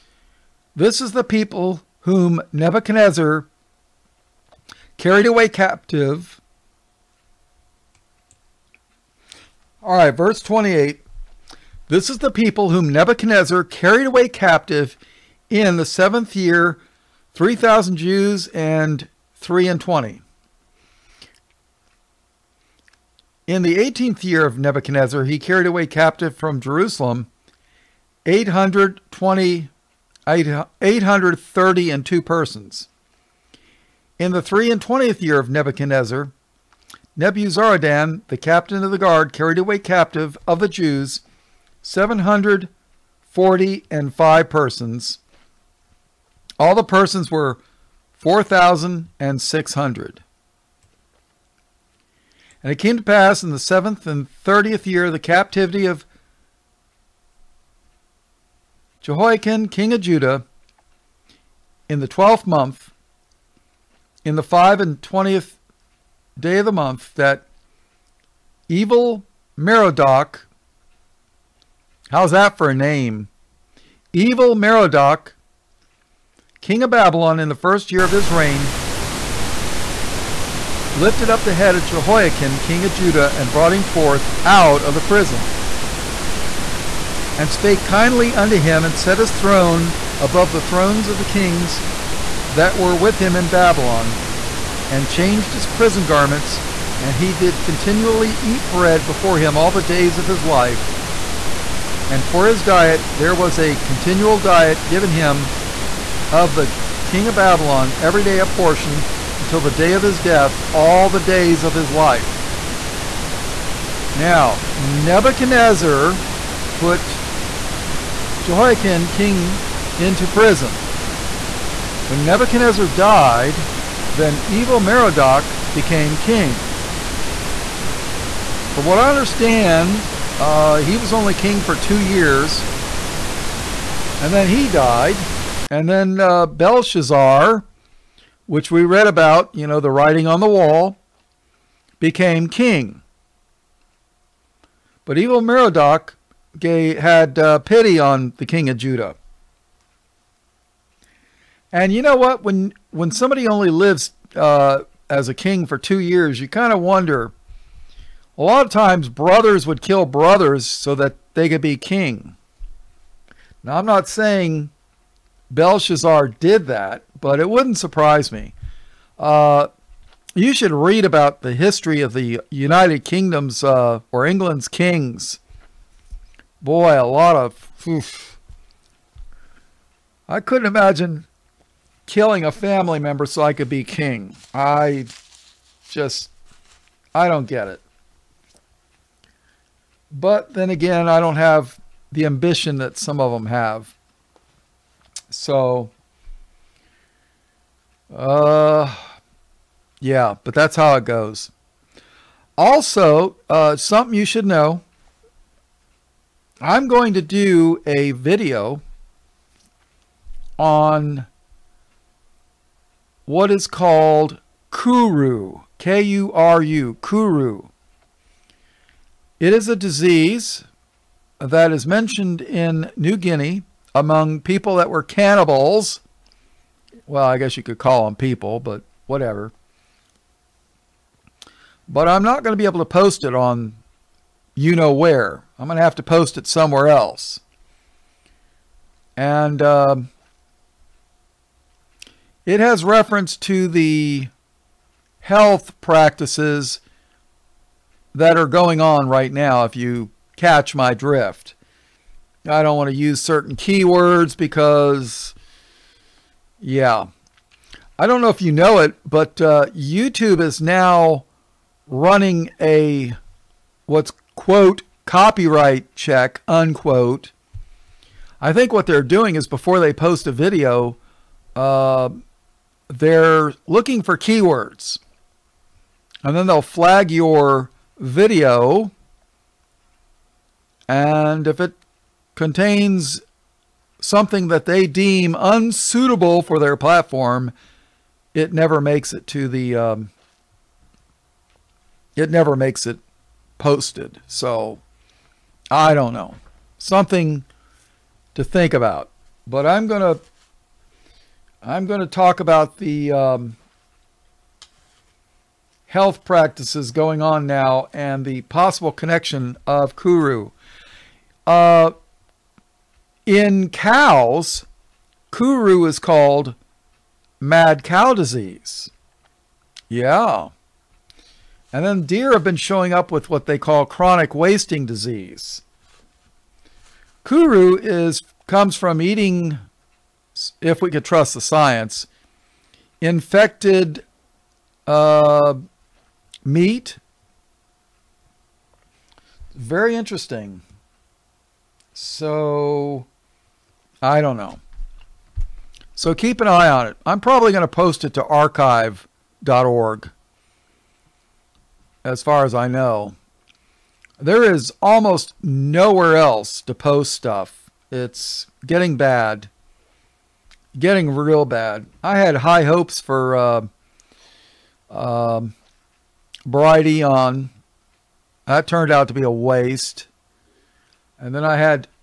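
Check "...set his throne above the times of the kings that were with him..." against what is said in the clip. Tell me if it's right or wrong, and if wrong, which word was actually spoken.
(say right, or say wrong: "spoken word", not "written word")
wrong: "thrones", not "times".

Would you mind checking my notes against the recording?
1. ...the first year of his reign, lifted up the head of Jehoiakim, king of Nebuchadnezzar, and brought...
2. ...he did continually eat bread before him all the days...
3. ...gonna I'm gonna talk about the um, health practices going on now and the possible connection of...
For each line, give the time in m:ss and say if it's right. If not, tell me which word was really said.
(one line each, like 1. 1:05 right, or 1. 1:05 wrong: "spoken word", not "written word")
1. 1:17 wrong: "Judah", not "Nebuchadnezzar"
2. 1:37 right
3. 4:59 right.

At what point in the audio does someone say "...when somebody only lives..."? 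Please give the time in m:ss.
2:32.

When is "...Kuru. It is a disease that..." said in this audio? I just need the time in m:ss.
3:37.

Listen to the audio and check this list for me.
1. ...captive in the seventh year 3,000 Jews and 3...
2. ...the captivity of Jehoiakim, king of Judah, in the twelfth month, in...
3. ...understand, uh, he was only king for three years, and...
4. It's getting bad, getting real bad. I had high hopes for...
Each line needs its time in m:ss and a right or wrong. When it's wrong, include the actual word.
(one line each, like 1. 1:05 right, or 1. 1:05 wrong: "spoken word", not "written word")
1. 0:14 right
2. 0:55 right
3. 2:09 wrong: "two", not "three"
4. 5:57 right.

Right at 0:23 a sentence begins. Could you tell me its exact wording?
In the 18th year of Nebuchadnezzar, he carried away captive from Jerusalem 820, 830 and two persons.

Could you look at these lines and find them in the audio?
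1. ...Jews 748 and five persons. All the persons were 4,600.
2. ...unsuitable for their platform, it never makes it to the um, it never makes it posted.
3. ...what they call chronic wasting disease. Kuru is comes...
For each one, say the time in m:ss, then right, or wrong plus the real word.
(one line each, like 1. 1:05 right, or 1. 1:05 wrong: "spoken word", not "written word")
1. 0:40 wrong: "740", not "748"
2. 4:45 right
3. 5:23 right.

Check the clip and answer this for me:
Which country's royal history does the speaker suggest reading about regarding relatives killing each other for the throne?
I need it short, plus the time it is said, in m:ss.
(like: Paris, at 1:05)
England, at 2:54.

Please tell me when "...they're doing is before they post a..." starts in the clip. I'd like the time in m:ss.
4:28.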